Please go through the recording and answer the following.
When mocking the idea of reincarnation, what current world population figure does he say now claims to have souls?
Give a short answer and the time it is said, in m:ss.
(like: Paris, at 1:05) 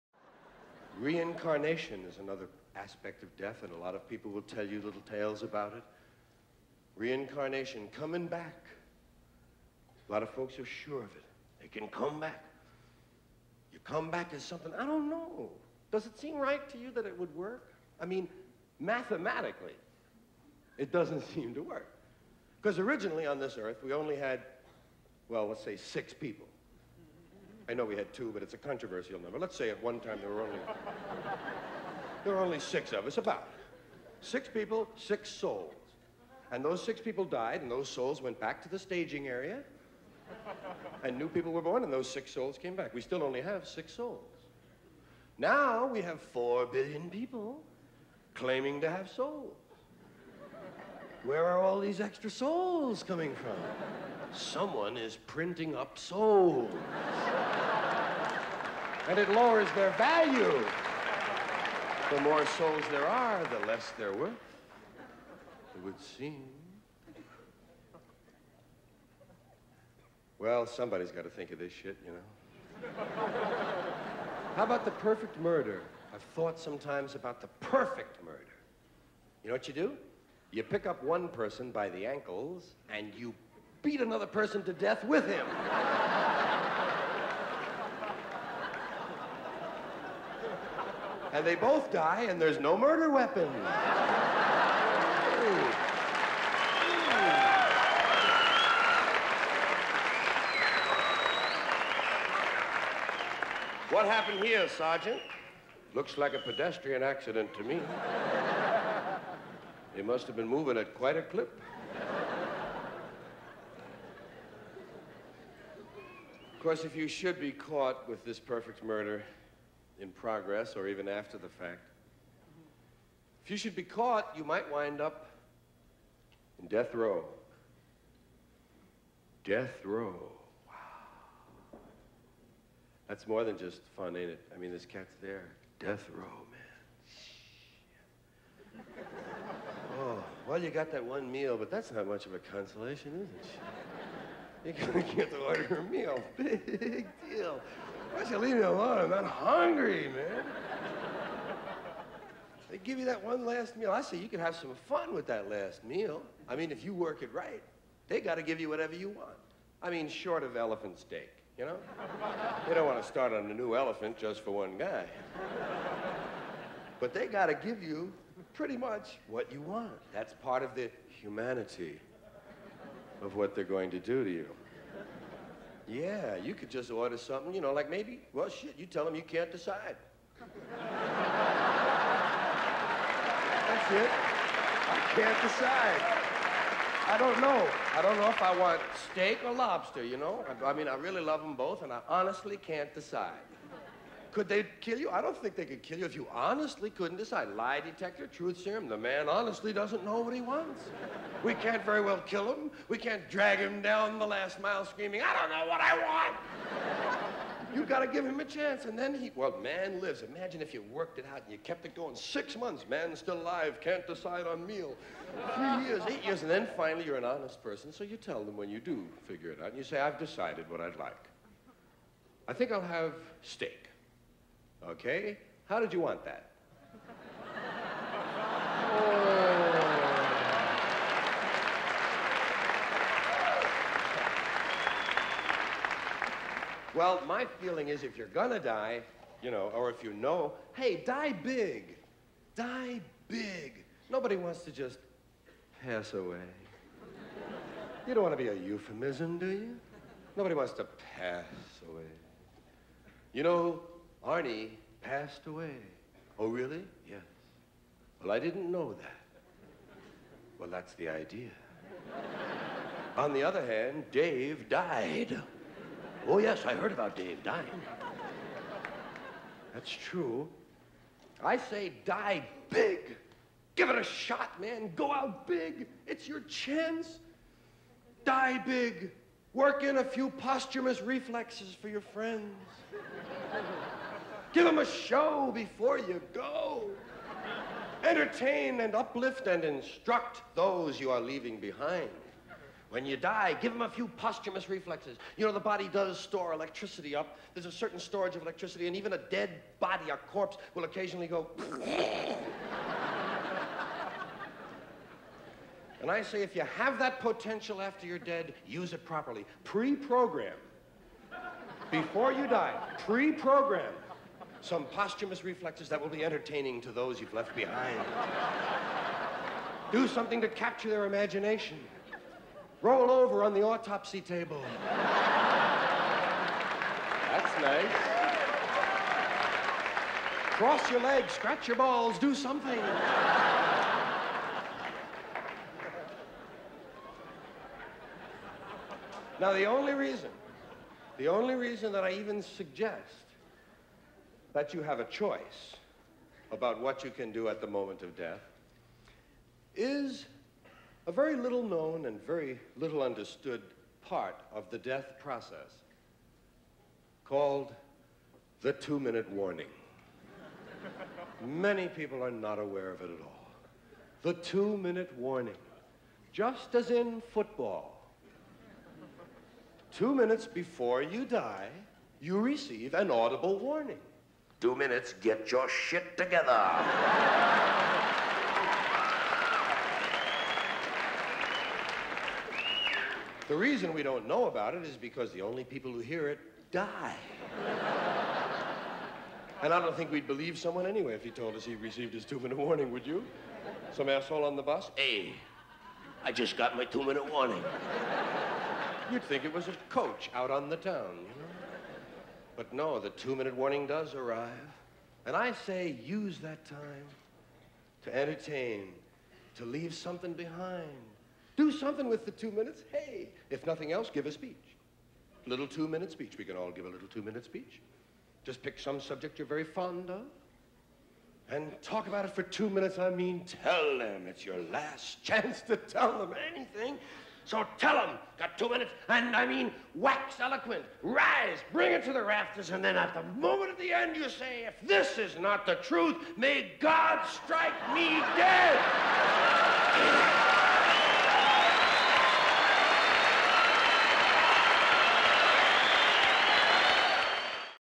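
4 billion, at 0:46.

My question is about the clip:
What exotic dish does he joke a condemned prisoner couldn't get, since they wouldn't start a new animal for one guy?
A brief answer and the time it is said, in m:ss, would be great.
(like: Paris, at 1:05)
Elephant steak, at 2:40.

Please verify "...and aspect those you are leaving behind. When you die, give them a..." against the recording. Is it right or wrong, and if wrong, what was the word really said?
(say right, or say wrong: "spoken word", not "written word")
wrong: "instruct", not "aspect".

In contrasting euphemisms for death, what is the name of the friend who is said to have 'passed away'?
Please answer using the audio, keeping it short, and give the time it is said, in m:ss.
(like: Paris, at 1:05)
Arnie, at 4:14.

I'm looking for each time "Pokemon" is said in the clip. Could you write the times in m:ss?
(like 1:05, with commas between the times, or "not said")
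not said.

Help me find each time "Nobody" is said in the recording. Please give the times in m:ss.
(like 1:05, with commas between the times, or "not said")
4:04, 4:10.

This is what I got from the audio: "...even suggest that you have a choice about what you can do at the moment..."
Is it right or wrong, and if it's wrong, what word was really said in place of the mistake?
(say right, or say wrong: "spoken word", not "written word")
right.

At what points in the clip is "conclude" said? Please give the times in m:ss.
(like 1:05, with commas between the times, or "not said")
not said.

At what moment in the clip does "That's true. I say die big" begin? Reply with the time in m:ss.
4:29.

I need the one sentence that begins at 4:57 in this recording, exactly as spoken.
There's a certain storage of electricity, and even a dead body, a corpse, will occasionally go.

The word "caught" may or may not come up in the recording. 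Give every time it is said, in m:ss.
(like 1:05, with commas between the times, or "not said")
1:57, 2:03.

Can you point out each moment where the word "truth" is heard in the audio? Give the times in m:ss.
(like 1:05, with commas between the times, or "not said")
3:18, 7:15.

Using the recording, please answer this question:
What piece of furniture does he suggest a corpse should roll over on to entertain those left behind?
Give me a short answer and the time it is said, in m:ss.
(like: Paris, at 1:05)
Autopsy table, at 5:23.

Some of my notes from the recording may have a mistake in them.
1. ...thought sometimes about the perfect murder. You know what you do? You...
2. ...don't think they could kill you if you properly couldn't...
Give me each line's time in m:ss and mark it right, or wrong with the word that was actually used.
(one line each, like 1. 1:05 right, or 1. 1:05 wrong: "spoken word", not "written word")
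1. 1:16 right
2. 3:15 wrong: "honestly", not "properly".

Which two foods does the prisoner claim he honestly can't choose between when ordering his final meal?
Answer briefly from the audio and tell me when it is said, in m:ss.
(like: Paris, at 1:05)
Steak or lobster, at 3:09.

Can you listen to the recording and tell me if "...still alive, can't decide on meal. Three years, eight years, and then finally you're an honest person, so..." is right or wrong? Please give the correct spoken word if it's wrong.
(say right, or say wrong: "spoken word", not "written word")
right.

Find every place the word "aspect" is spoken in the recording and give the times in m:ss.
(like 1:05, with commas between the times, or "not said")
0:02.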